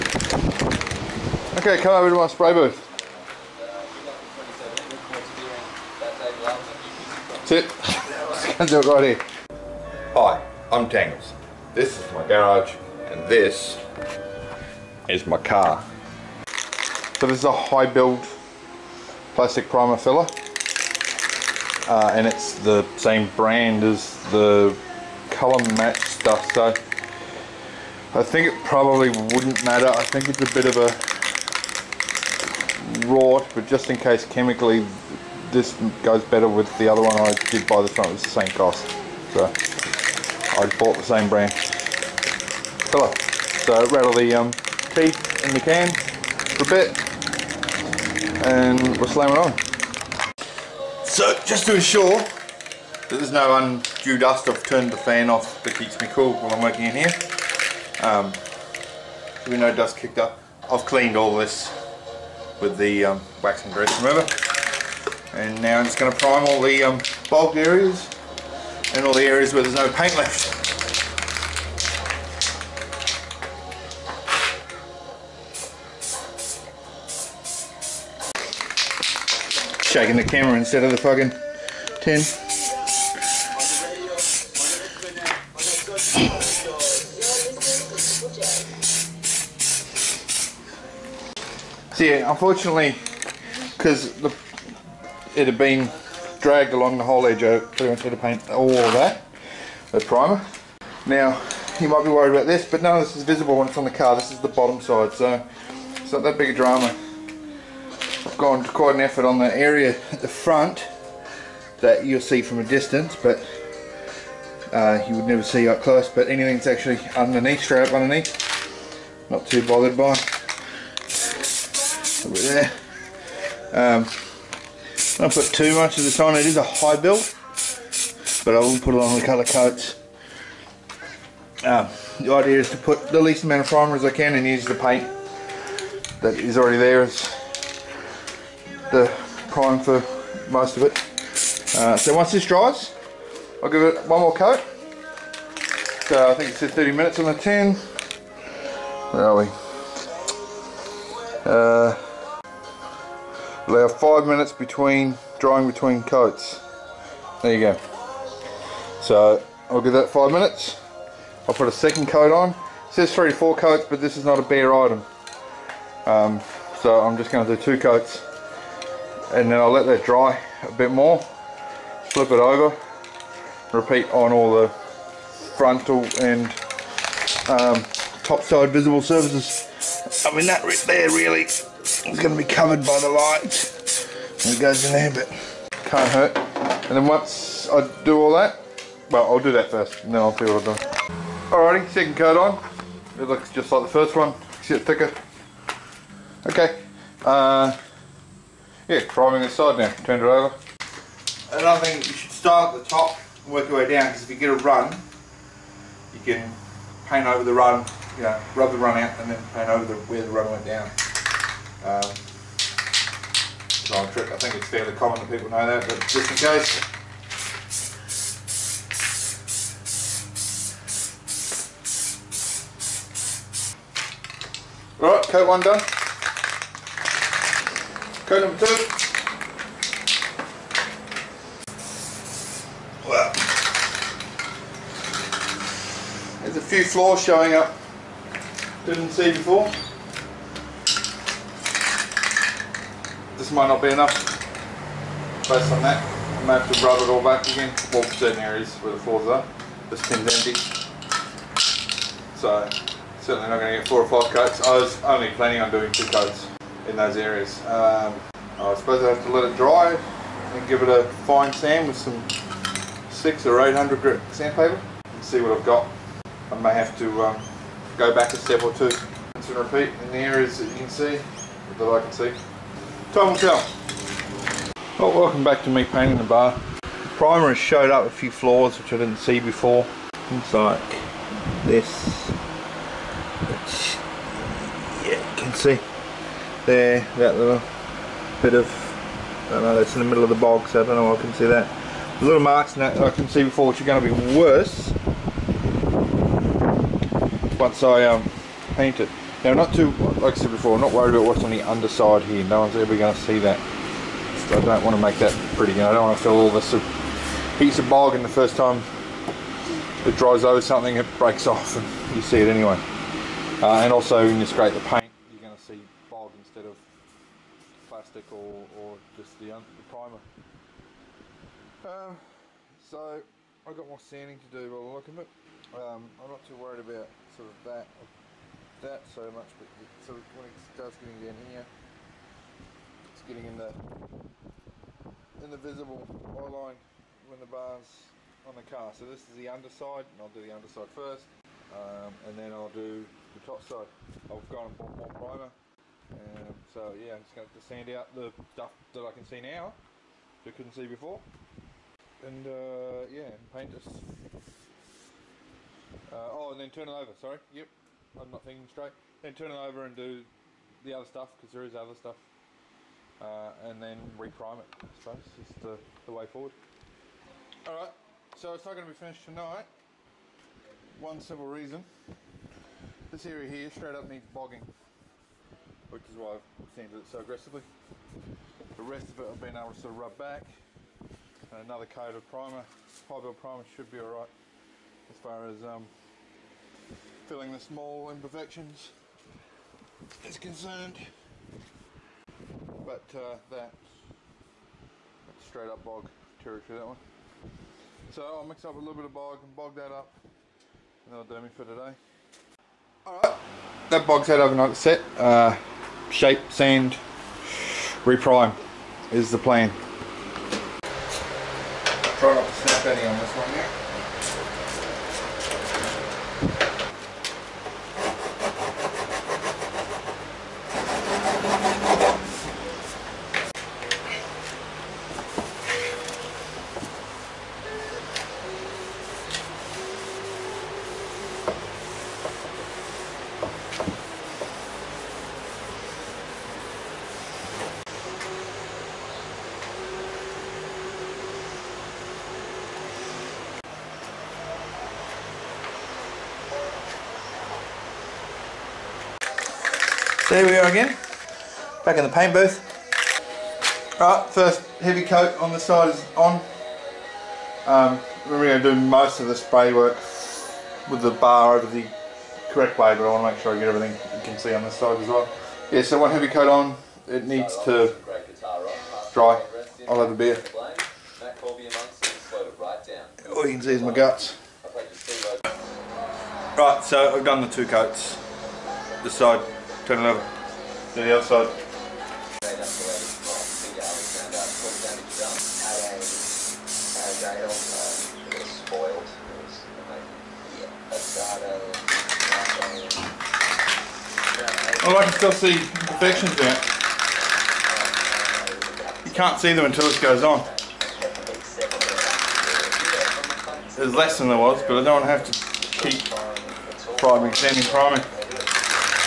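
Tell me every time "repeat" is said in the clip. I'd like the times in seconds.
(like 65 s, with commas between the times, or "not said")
173 s, 269 s.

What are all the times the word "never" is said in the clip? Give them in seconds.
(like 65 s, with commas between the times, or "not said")
115 s.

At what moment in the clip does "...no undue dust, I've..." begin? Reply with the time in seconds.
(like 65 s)
53 s.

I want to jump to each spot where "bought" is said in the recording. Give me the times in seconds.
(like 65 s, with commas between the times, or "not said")
40 s, 344 s.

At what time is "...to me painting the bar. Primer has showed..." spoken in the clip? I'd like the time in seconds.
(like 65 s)
275 s.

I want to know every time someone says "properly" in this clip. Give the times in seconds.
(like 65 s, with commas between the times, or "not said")
not said.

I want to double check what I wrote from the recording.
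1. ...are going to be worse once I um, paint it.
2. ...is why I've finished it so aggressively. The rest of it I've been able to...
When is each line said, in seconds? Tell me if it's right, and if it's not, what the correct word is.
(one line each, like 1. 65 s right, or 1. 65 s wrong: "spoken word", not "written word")
1. 293 s right
2. 376 s wrong: "sanded", not "finished".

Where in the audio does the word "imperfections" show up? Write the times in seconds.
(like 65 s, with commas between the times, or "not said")
388 s, 495 s.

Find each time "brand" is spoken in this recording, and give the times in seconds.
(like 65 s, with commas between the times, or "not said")
23 s, 41 s.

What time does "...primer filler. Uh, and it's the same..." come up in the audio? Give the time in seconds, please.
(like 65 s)
19 s.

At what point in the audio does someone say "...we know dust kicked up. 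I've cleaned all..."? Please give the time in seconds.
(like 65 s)
59 s.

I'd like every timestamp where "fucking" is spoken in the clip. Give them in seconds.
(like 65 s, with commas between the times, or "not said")
80 s.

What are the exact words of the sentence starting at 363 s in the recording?
Uh, and then reprime it, I suppose, is the, the way forward.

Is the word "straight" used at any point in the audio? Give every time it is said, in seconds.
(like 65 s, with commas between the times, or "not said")
117 s, 358 s, 373 s, 395 s.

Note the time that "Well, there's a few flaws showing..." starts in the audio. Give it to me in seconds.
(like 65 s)
233 s.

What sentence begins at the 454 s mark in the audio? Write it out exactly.
Right, first heavy coat on the side is on.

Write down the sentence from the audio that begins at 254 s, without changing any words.
I was only planning on doing two coats in those areas.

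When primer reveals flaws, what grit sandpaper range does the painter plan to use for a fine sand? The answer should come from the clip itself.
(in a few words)
600 or 800.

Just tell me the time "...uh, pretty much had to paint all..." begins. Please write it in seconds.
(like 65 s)
97 s.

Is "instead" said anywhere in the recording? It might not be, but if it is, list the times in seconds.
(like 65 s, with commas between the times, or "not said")
80 s, 316 s.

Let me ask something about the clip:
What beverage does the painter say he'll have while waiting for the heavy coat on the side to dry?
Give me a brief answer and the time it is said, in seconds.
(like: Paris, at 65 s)
a beer, at 470 s.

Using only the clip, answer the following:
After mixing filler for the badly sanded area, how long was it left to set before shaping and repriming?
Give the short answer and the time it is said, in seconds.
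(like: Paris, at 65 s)
overnight, at 404 s.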